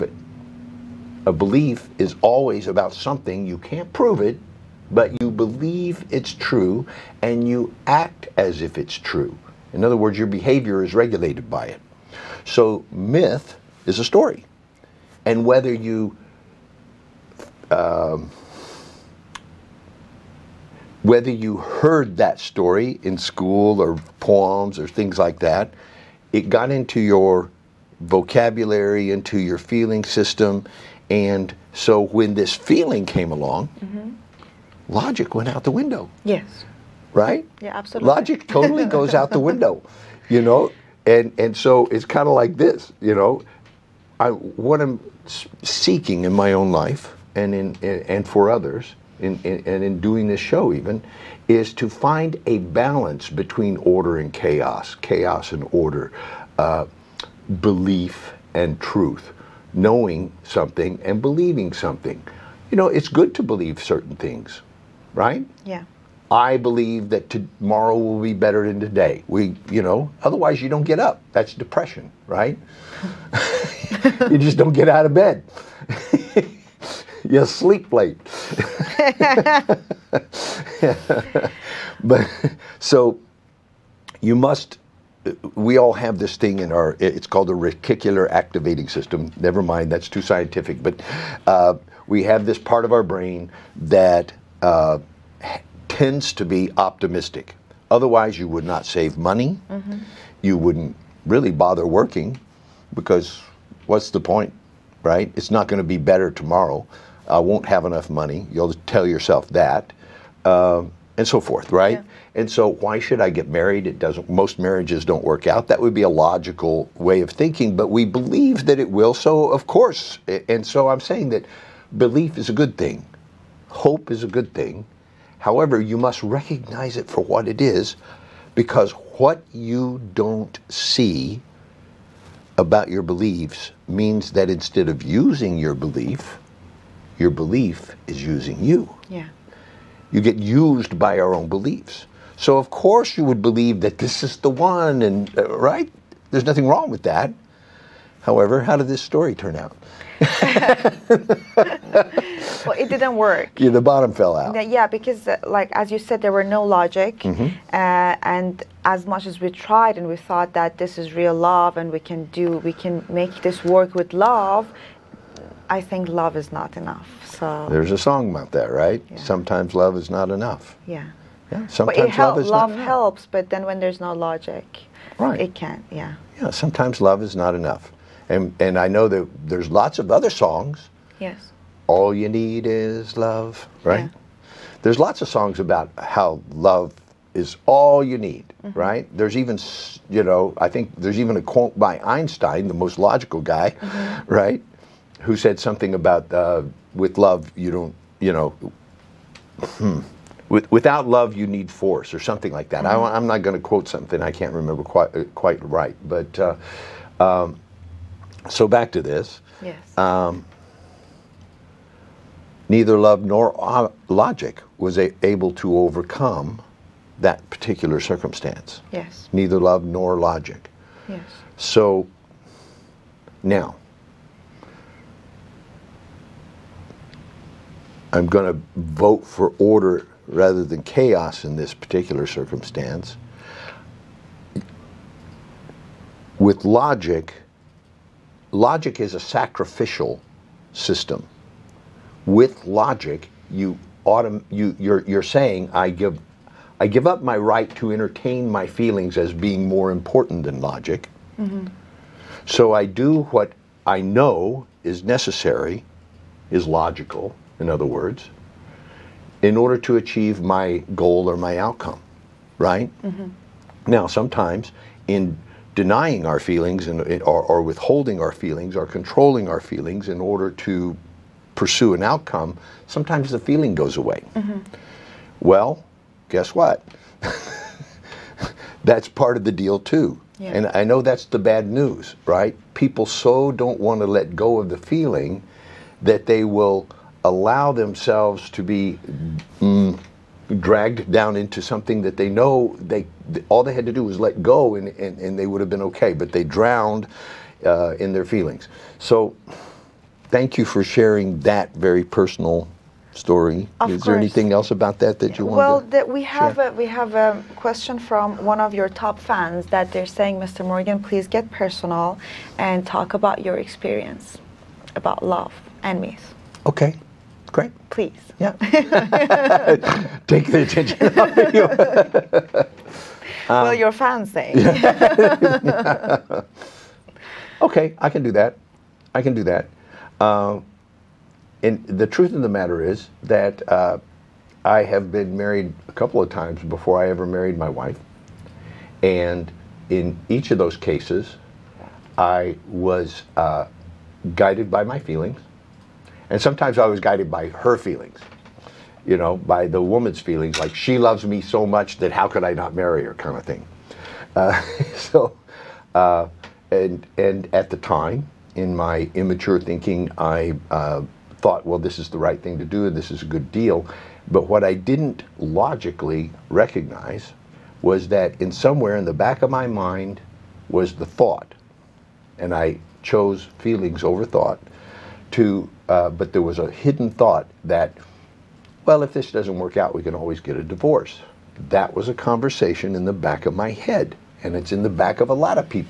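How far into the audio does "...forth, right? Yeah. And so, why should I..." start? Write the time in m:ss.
1:51.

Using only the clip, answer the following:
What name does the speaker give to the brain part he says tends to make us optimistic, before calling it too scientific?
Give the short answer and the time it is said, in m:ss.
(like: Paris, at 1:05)
reticular activating system, at 1:27.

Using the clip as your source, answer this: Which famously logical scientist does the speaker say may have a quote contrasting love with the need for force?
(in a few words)
Einstein.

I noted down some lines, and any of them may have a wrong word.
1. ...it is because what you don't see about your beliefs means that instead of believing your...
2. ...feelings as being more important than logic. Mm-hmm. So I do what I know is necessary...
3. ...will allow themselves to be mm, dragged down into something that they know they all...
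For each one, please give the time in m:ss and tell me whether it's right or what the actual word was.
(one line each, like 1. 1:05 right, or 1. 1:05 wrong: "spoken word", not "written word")
1. 2:07 wrong: "using", not "believing"
2. 4:08 right
3. 4:46 right.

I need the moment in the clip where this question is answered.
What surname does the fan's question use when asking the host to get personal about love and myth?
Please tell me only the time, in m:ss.
5:10.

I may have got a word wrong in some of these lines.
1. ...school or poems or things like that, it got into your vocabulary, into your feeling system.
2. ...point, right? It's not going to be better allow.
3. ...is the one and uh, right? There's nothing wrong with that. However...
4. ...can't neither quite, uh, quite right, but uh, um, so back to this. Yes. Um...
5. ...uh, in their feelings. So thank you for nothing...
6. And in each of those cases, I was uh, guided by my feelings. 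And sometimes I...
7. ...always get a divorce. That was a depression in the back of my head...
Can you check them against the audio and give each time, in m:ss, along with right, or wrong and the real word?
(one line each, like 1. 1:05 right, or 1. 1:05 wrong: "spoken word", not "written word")
1. 0:23 right
2. 1:44 wrong: "tomorrow", not "allow"
3. 2:24 right
4. 3:24 wrong: "remember", not "neither"
5. 4:57 wrong: "sharing", not "nothing"
6. 5:39 right
7. 6:20 wrong: "conversation", not "depression".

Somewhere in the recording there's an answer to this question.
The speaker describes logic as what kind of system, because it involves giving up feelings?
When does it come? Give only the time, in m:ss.
3:59.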